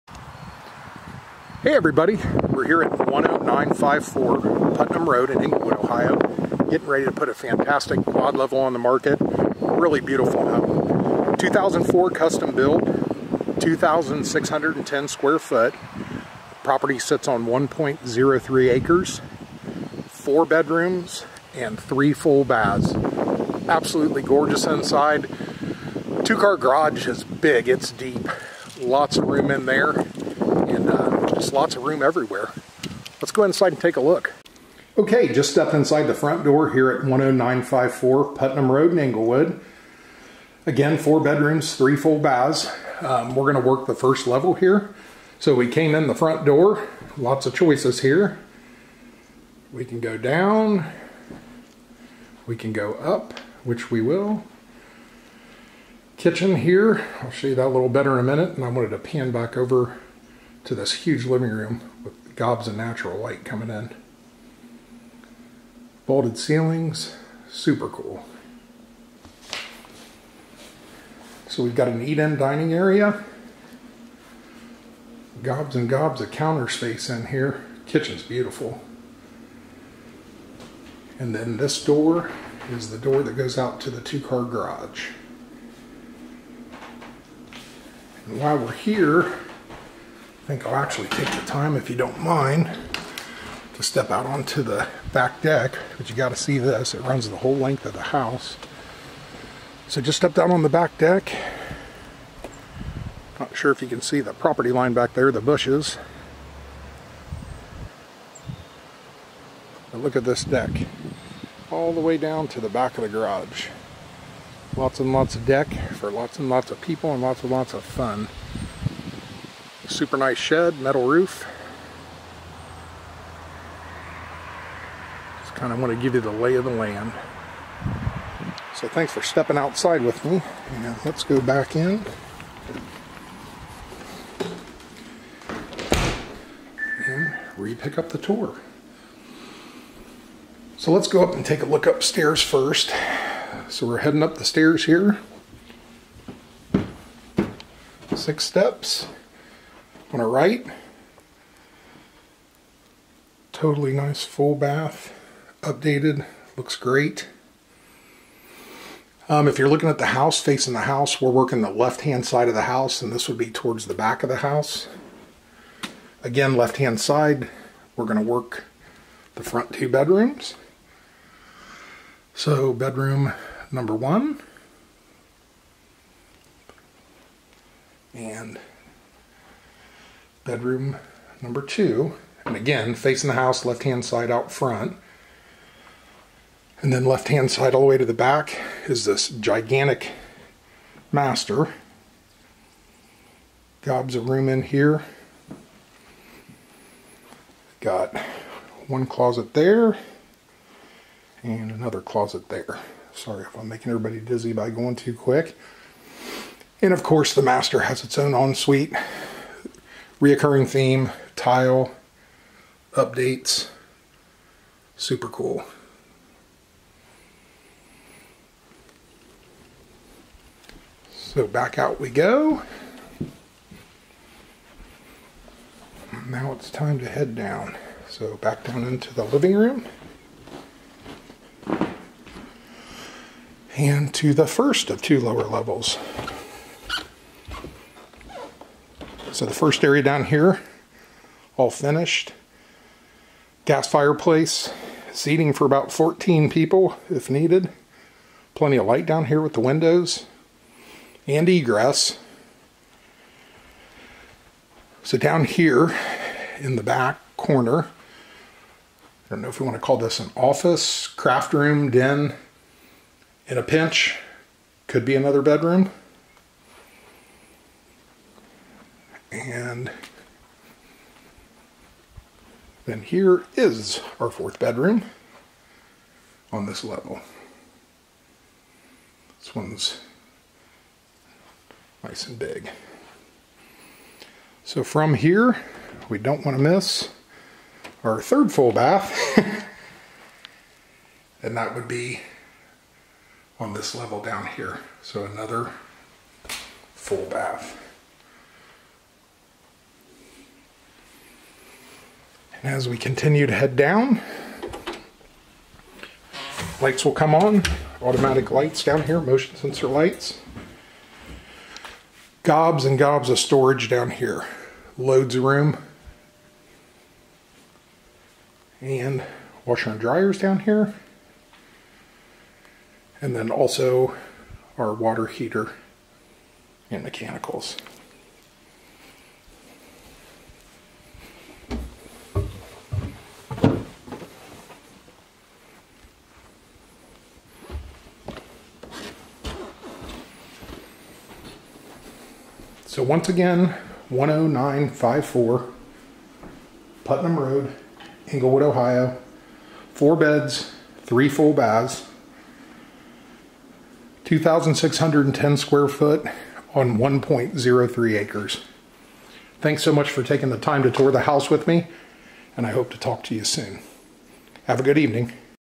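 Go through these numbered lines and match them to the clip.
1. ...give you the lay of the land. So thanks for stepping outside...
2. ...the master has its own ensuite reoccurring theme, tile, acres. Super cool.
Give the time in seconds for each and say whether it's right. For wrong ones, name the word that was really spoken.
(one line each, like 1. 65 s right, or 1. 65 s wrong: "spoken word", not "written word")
1. 126 s right
2. 207 s wrong: "updates", not "acres".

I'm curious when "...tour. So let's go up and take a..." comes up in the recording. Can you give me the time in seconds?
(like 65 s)
138 s.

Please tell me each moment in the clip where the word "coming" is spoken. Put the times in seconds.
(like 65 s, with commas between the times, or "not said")
63 s.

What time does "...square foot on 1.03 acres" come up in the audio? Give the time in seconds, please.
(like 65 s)
355 s.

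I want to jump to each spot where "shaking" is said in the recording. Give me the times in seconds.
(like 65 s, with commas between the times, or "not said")
not said.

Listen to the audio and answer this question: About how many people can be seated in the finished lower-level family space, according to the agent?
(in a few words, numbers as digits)
14.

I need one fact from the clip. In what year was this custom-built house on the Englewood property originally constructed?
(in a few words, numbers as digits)
2004.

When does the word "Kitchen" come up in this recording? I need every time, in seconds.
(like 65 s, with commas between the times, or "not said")
56 s, 77 s.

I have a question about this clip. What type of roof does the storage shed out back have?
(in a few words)
Metal.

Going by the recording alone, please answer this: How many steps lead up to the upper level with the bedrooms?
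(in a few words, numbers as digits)
6.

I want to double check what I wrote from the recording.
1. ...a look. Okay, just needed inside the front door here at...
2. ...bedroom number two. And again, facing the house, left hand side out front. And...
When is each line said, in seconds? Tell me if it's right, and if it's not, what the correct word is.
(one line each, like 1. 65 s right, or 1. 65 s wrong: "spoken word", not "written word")
1. 33 s wrong: "stepped", not "needed"
2. 180 s right.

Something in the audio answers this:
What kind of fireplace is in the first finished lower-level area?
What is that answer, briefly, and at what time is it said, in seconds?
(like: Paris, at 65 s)
Gas, at 243 s.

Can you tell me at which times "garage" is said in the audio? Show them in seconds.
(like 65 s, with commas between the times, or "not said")
26 s, 84 s, 113 s.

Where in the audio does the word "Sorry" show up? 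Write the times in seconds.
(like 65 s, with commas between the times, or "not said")
203 s.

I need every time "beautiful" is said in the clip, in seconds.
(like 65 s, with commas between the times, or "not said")
10 s, 78 s.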